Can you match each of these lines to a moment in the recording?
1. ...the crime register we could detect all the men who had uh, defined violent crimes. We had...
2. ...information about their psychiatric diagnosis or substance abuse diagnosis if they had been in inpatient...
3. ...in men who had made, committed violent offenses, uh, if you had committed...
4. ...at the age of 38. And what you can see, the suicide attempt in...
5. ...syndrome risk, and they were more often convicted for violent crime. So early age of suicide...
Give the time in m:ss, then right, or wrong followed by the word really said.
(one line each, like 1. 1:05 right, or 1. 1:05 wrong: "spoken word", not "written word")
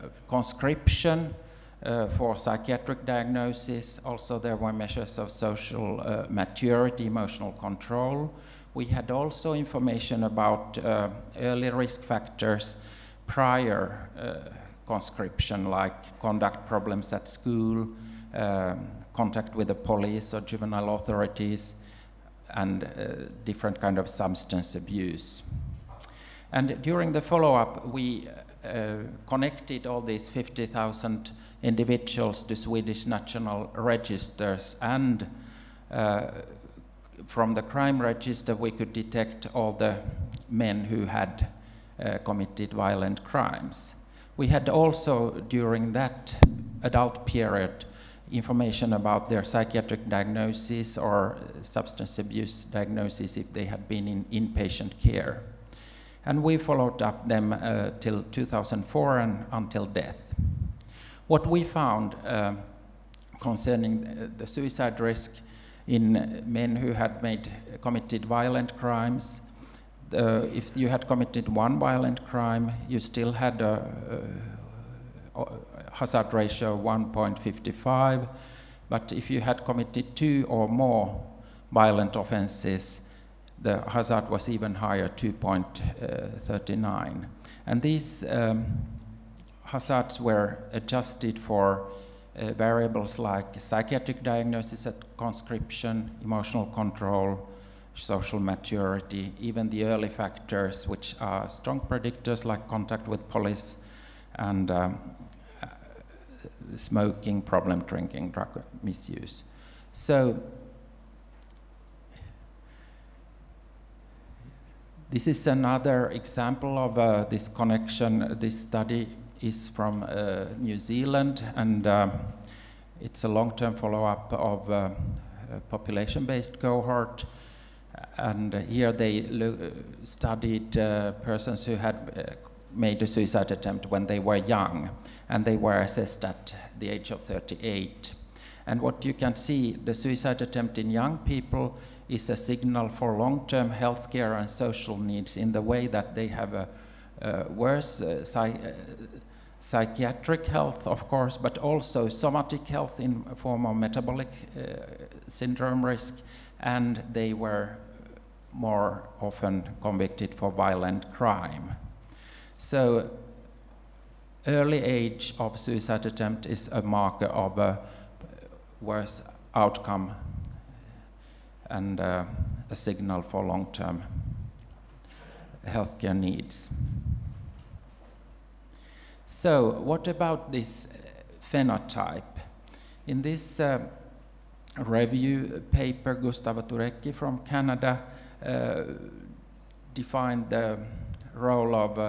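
1. 0:37 wrong: "committed", not "defined"
2. 0:48 right
3. 1:05 wrong: "crimes", not "offenses"
4. 2:16 right
5. 2:35 right.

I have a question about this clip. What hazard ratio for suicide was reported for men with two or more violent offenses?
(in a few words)
2.39.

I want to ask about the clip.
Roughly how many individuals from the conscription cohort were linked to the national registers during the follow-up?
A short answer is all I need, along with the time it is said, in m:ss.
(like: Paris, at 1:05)
50,000, at 0:30.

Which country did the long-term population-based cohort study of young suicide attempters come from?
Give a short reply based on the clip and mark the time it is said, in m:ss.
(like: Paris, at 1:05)
New Zealand, at 2:00.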